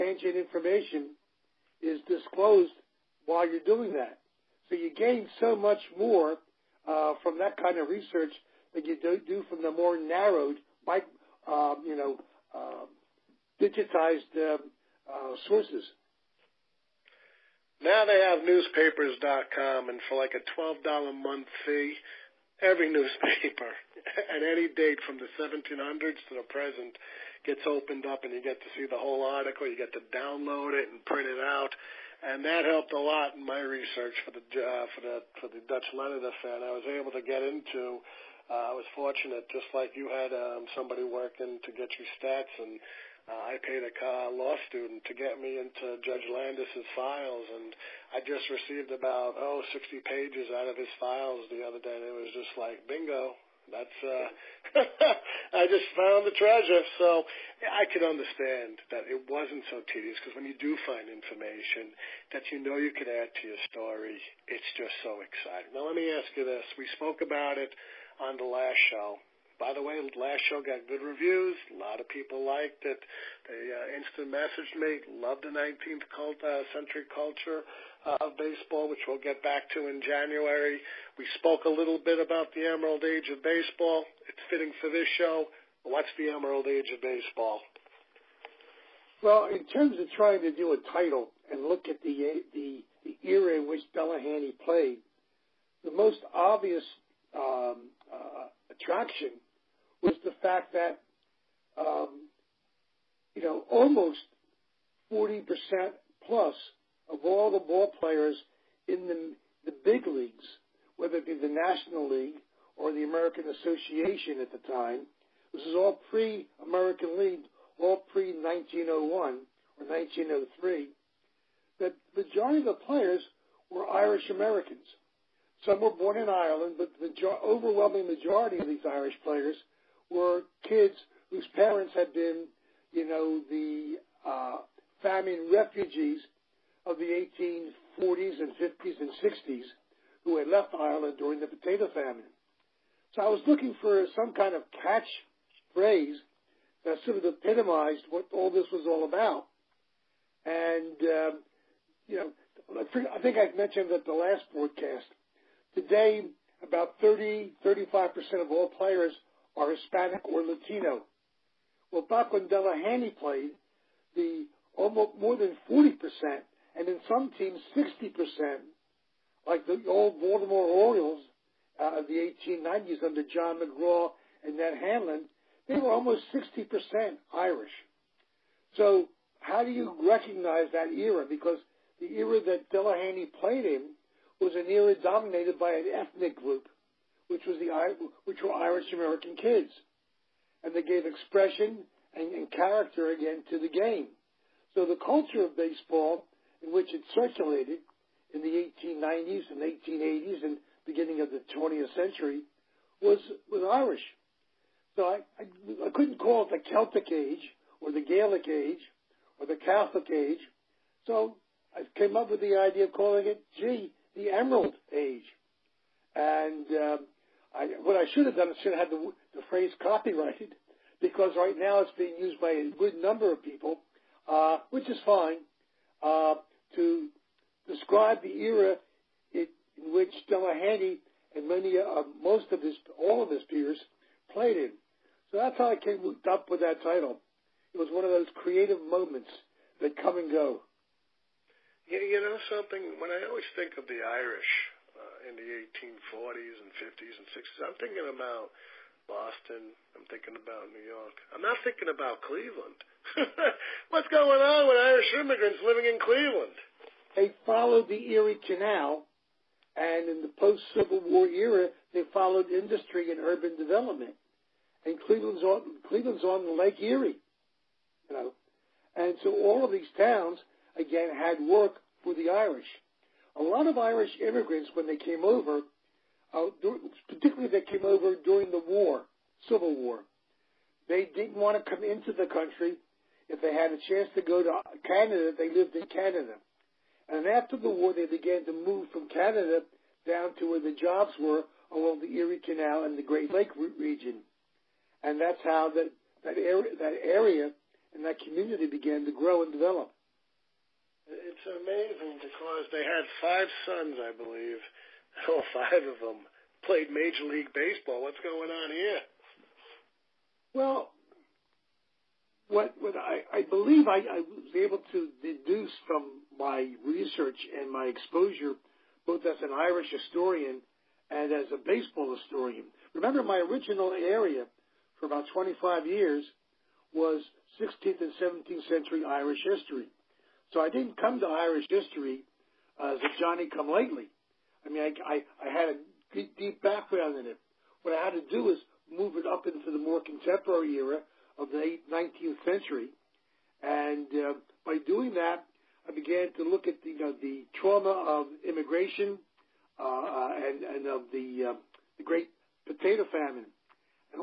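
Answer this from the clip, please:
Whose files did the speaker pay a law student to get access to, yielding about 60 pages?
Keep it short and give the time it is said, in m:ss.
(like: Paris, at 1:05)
Judge Landis, at 0:46.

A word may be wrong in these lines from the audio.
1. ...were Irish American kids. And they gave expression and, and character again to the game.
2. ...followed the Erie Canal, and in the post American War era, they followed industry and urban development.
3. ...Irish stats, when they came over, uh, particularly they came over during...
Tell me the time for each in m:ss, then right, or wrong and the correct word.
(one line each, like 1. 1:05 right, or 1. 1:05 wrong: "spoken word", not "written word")
1. 3:08 right
2. 4:17 wrong: "Civil", not "American"
3. 4:33 wrong: "immigrants", not "stats".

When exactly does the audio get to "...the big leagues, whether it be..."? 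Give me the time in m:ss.
1:49.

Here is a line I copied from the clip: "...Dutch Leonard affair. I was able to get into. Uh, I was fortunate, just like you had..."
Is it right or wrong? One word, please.
right.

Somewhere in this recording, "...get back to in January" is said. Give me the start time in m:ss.
1:19.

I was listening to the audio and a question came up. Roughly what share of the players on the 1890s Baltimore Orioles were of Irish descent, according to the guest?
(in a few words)
60%.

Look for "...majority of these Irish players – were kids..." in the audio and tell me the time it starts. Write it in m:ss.
2:08.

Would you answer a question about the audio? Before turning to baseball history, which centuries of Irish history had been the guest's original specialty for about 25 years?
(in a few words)
16th and 17th century.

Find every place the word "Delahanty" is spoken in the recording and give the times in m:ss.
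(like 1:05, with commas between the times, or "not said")
1:33, 2:42, 3:02, 3:50.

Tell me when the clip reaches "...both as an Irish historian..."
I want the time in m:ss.
5:19.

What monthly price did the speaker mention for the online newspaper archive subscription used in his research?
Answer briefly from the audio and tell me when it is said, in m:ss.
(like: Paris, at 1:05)
$12, at 0:20.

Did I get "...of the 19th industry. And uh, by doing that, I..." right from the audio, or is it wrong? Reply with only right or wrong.
wrong.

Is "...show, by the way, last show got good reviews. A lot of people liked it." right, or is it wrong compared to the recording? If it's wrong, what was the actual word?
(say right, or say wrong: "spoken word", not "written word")
right.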